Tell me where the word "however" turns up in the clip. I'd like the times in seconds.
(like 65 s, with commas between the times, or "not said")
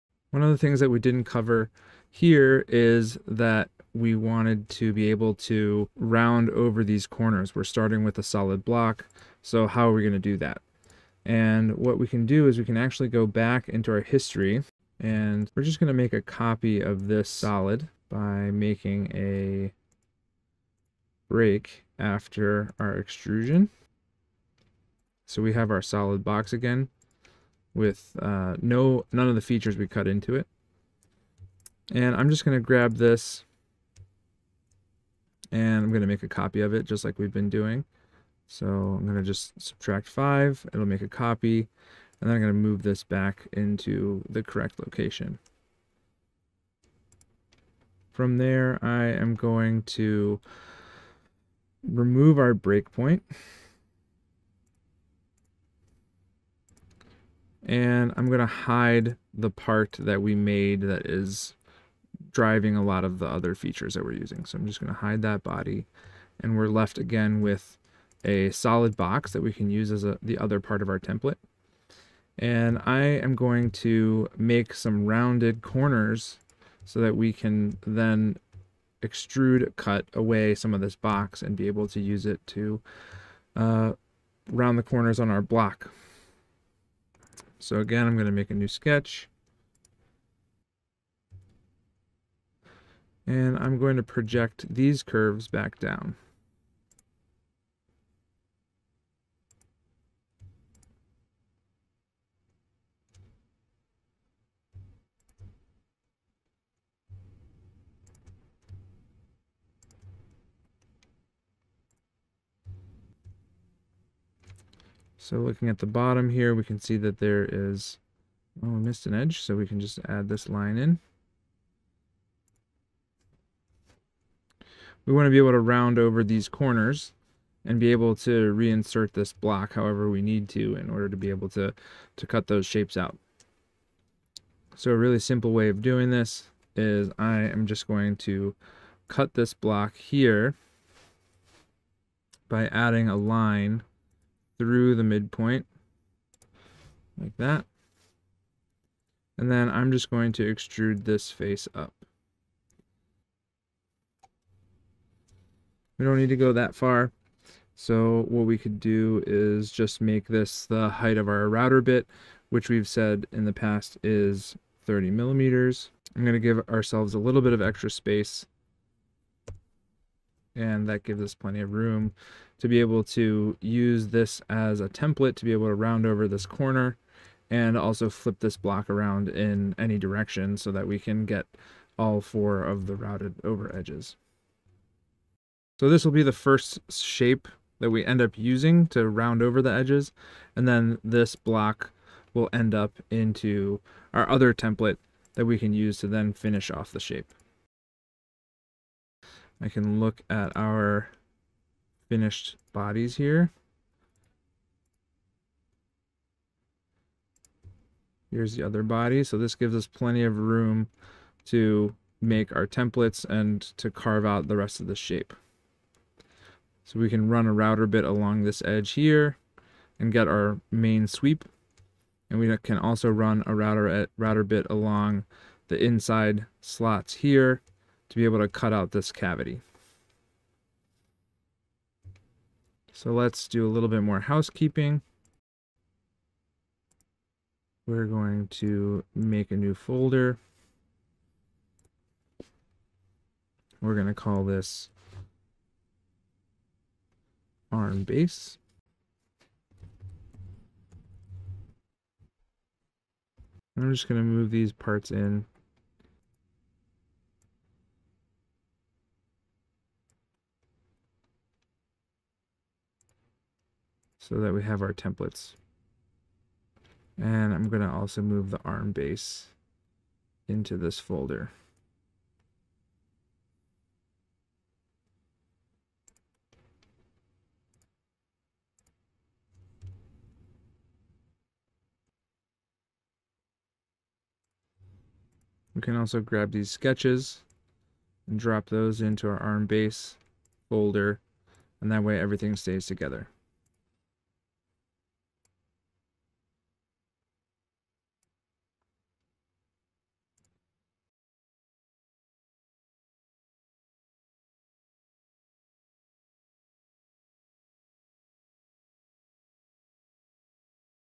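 129 s.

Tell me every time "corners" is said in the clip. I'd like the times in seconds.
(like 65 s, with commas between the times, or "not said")
7 s, 75 s, 84 s, 126 s, 176 s.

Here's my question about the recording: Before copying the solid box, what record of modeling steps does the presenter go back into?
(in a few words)
History.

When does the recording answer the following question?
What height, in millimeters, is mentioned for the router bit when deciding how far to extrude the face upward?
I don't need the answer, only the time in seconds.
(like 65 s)
164 s.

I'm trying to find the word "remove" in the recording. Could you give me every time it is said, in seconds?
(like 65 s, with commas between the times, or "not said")
51 s.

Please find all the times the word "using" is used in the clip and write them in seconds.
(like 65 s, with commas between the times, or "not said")
64 s, 188 s.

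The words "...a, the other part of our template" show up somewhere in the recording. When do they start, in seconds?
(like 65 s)
70 s.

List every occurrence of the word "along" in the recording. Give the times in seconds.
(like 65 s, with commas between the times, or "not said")
218 s, 224 s.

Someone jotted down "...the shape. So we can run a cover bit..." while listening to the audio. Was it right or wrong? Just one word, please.
wrong.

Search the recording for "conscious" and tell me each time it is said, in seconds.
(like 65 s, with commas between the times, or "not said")
not said.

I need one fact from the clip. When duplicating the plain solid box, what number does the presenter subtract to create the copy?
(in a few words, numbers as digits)
5.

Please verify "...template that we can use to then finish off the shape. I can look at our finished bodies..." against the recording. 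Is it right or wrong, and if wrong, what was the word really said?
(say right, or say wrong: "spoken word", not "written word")
right.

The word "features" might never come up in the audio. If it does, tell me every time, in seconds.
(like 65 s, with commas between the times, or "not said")
29 s, 63 s.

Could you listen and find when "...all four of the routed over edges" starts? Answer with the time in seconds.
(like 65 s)
181 s.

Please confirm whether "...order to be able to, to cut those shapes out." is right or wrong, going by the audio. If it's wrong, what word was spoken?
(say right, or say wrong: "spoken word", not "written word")
right.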